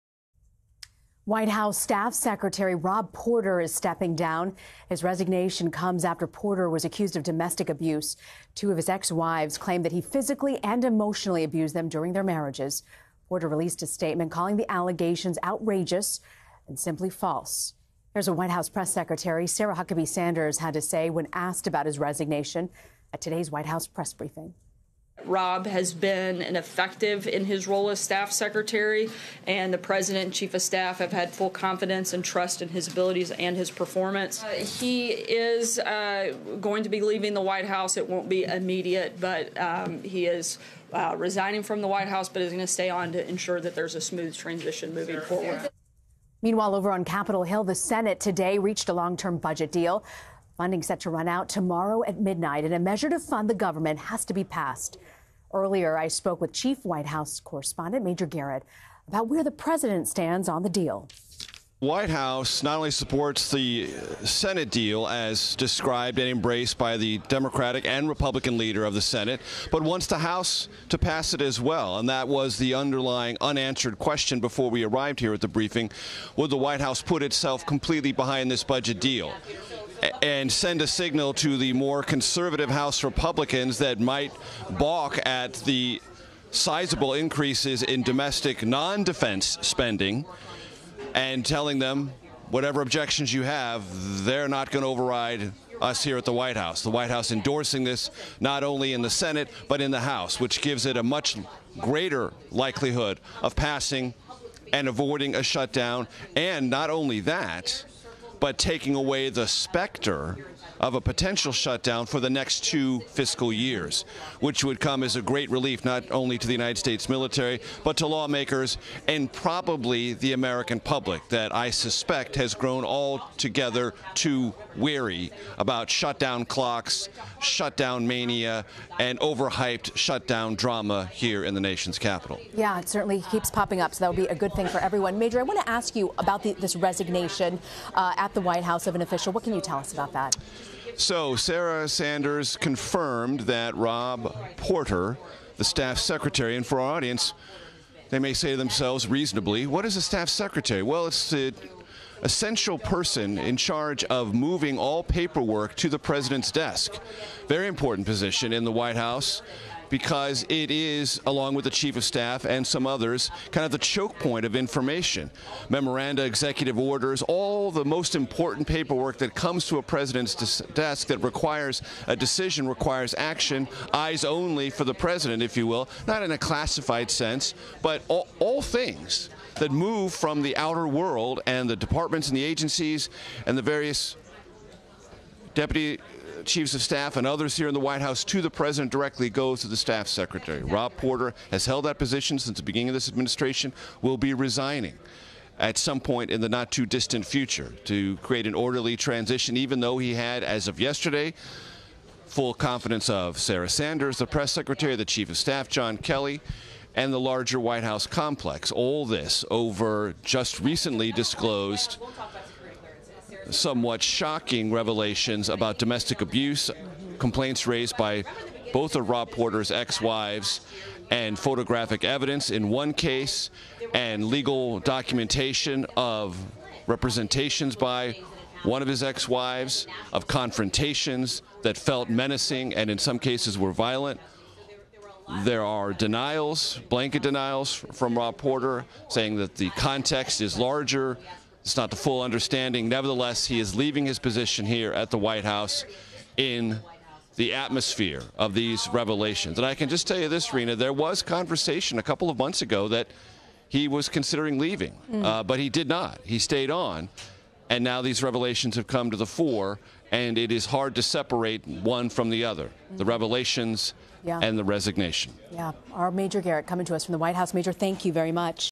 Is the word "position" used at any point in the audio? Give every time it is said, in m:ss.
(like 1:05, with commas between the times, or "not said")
2:38, 3:11, 4:04.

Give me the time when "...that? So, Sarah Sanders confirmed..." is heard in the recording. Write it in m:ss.
2:20.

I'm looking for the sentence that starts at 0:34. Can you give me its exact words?
Uh, he is uh, going to be leaving the White House.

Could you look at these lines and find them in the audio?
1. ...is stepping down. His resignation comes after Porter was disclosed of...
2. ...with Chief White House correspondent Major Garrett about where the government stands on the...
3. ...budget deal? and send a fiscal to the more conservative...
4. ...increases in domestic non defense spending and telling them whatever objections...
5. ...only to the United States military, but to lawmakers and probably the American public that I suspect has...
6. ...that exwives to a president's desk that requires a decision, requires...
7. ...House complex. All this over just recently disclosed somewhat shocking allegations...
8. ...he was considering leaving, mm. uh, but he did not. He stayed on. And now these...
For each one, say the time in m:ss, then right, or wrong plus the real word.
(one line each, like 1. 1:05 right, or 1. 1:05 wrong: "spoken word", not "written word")
1. 0:03 wrong: "accused", not "disclosed"
2. 0:56 wrong: "president", not "government"
3. 1:18 wrong: "signal", not "fiscal"
4. 1:27 right
5. 1:56 right
6. 2:49 wrong: "comes", not "exwives"
7. 3:27 wrong: "revelations", not "allegations"
8. 4:13 right.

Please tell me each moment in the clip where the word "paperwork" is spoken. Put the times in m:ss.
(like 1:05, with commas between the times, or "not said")
2:35, 2:48.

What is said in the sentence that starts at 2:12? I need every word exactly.
Yeah, it certainly keeps popping up, so that would be a good thing for everyone.